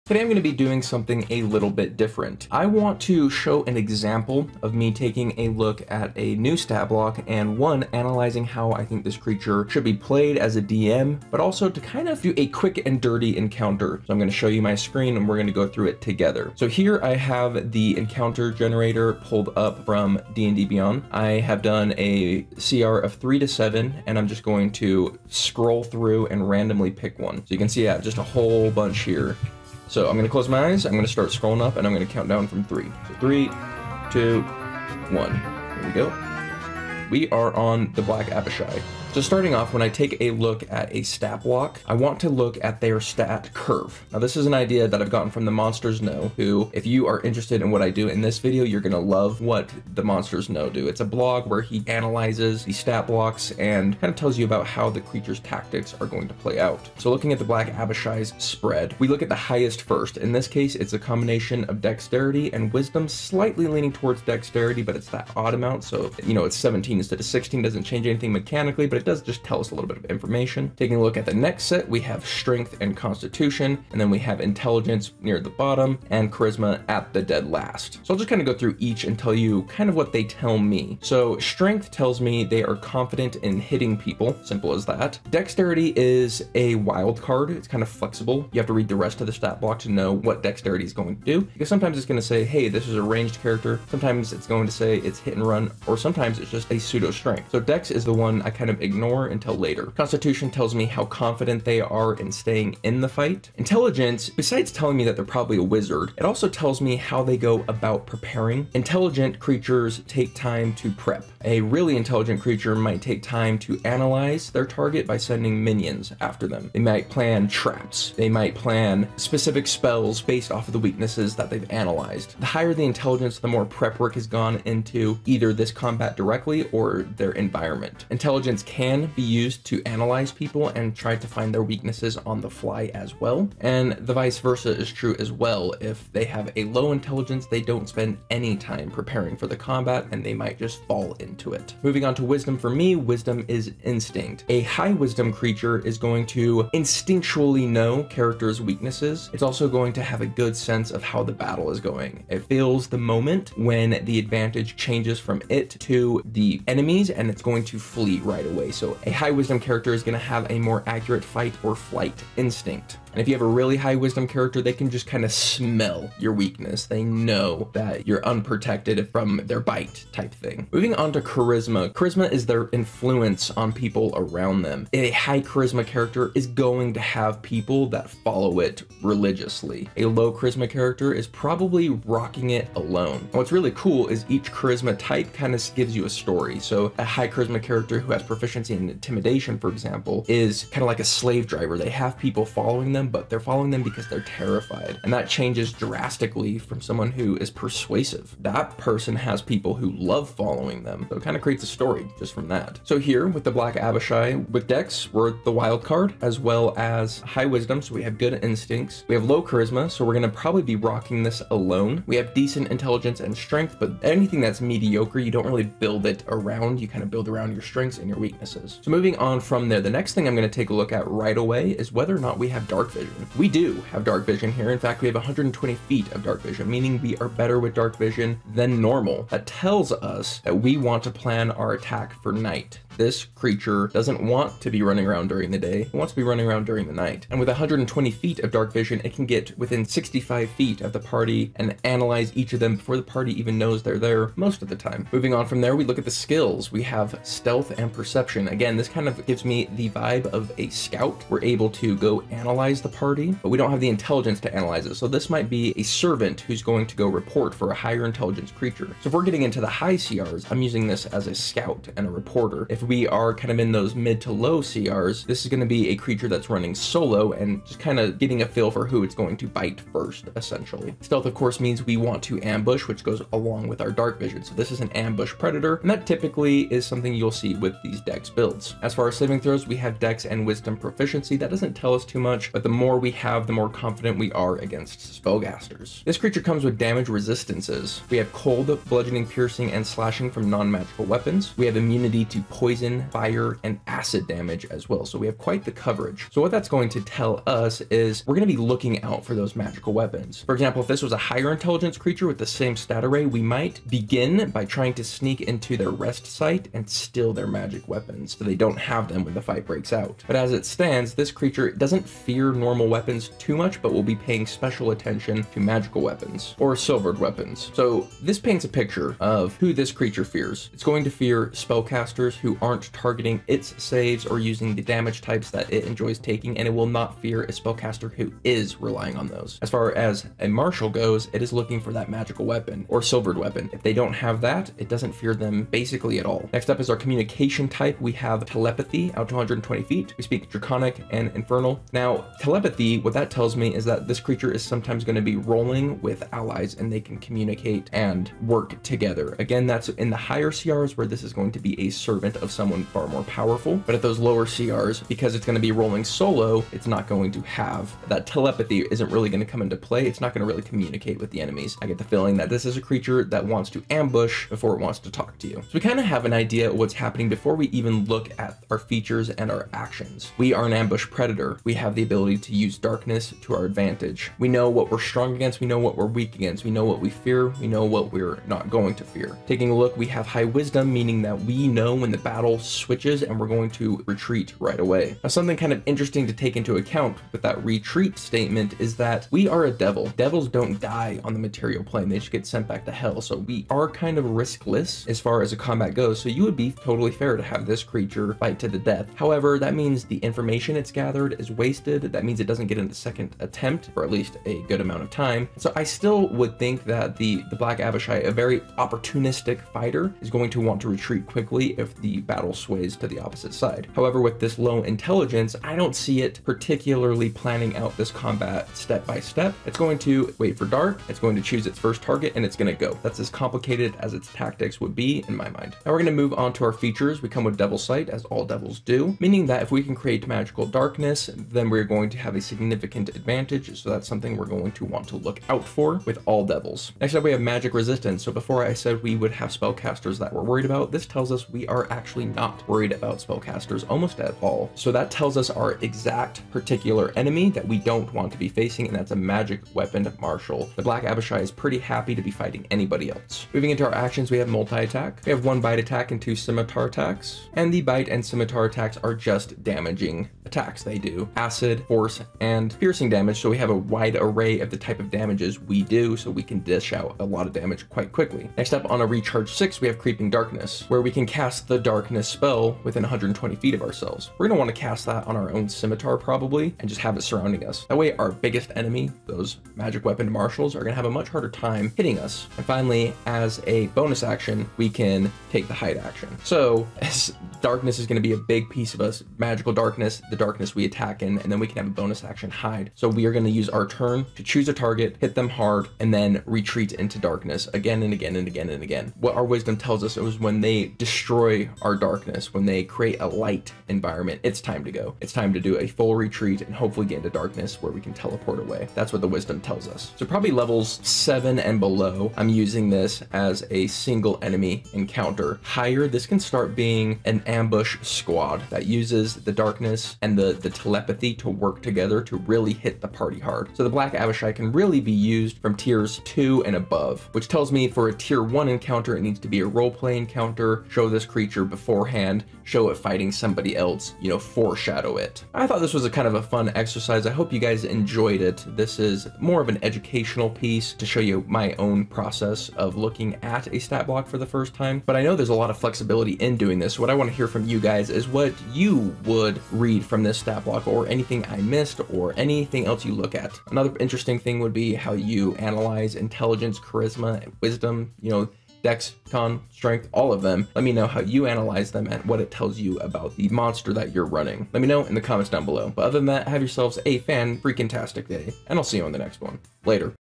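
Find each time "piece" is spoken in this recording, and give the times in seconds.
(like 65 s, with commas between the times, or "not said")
488 s, 540 s.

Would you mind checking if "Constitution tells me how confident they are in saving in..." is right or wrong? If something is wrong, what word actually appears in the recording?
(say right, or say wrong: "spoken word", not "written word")
wrong: "staying", not "saving".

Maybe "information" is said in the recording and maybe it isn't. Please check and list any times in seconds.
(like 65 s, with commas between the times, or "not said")
70 s, 400 s.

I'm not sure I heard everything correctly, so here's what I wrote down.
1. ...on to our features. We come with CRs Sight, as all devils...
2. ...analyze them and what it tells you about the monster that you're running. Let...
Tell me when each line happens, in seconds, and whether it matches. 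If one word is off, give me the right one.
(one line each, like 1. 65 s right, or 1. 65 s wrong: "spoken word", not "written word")
1. 426 s wrong: "Devil", not "CRs"
2. 561 s right.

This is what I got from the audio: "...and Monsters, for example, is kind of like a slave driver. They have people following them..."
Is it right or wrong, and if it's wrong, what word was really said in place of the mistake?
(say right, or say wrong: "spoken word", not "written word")
wrong: "Intimidation", not "Monsters".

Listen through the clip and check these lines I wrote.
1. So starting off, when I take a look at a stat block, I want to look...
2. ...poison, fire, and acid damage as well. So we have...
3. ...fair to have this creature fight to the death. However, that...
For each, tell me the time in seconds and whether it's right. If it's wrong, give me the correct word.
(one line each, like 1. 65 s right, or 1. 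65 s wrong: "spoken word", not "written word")
1. 39 s right
2. 292 s right
3. 397 s right.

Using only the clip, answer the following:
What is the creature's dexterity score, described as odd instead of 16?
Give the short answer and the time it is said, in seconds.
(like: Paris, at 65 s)
17, at 66 s.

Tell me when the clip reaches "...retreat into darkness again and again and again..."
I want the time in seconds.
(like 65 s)
496 s.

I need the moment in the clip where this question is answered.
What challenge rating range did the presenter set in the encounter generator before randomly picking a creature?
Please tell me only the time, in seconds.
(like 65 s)
23 s.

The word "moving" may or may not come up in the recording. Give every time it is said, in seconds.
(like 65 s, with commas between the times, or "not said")
141 s, 170 s, 218 s, 245 s, 453 s.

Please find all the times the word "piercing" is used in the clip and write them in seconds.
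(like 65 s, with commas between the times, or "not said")
289 s, 462 s.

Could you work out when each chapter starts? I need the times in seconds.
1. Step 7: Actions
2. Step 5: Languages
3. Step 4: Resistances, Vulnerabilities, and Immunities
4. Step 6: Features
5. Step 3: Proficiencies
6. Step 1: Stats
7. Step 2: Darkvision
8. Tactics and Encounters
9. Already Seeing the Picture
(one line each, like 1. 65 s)
1. 453 s
2. 336 s
3. 286 s
4. 426 s
5. 245 s
6. 39 s
7. 218 s
8. 486 s
9. 364 s.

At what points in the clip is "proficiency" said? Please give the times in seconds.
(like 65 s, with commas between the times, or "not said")
188 s, 280 s.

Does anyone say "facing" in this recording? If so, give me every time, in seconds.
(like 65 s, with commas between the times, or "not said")
448 s.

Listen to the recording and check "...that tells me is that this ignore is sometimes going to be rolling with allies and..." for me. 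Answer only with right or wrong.
wrong.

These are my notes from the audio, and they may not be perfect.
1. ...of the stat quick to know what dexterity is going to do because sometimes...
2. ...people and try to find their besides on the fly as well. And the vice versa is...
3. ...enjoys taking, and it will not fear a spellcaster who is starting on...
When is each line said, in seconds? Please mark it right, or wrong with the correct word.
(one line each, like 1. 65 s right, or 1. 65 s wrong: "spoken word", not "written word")
1. 89 s wrong: "block", not "quick"
2. 130 s wrong: "weaknesses", not "besides"
3. 325 s wrong: "relying", not "starting".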